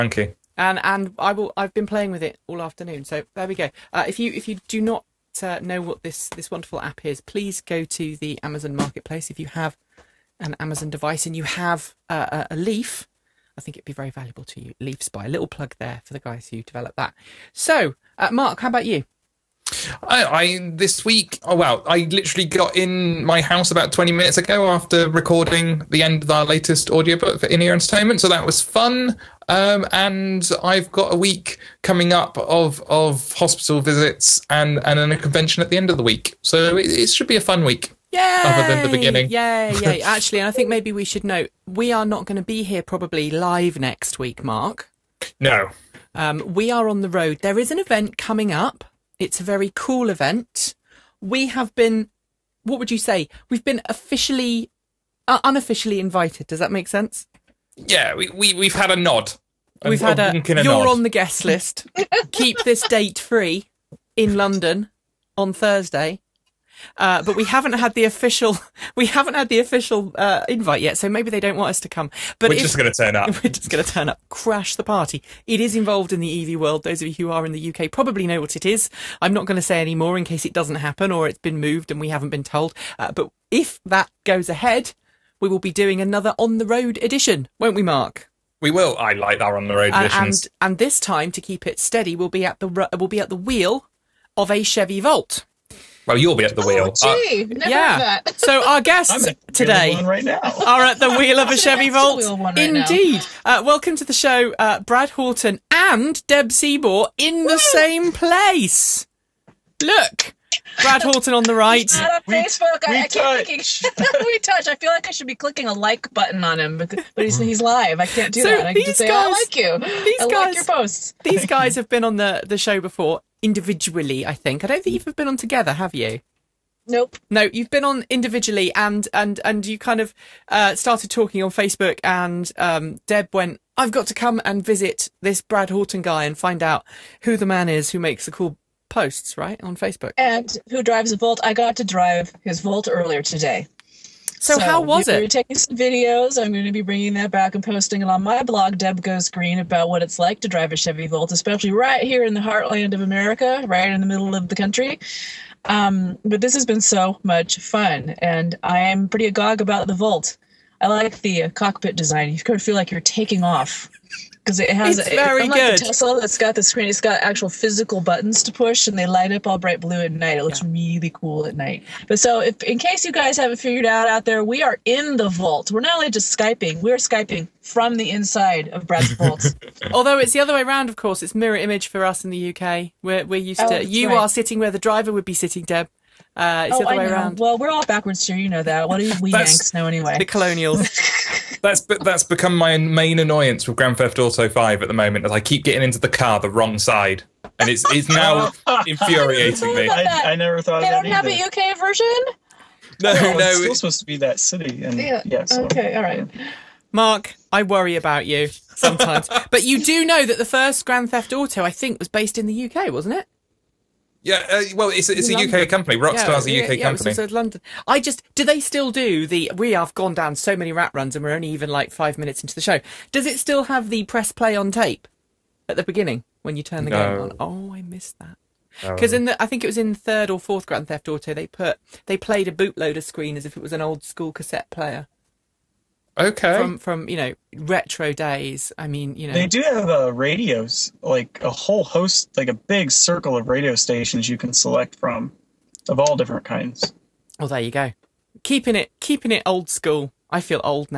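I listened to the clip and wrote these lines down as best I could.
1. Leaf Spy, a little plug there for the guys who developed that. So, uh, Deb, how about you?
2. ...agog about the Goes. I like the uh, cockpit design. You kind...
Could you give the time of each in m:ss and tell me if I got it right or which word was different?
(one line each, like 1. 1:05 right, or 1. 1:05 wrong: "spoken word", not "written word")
1. 0:14 wrong: "Mark", not "Deb"
2. 2:39 wrong: "Volt", not "Goes".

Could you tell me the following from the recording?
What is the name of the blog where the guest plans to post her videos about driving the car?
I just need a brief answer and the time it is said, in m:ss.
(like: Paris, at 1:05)
Deb Goes Green, at 2:28.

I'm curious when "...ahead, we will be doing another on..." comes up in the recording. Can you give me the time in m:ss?
1:24.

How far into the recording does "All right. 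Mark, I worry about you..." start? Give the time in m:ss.
3:25.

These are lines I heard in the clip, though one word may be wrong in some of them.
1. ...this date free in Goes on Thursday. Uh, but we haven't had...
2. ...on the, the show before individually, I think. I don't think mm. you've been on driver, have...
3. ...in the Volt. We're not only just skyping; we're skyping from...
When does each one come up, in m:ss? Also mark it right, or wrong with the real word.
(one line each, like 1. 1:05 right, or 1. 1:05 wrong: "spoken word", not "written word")
1. 1:02 wrong: "London", not "Goes"
2. 2:02 wrong: "together", not "driver"
3. 2:54 right.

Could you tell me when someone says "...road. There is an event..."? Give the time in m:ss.
0:47.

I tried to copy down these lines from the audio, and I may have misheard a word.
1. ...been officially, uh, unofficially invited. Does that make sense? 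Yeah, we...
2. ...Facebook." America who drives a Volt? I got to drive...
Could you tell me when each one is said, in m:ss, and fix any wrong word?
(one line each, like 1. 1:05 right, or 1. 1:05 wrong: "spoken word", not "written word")
1. 0:53 right
2. 2:19 wrong: "And", not "America".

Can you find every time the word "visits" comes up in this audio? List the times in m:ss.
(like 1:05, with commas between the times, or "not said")
0:33, 2:14.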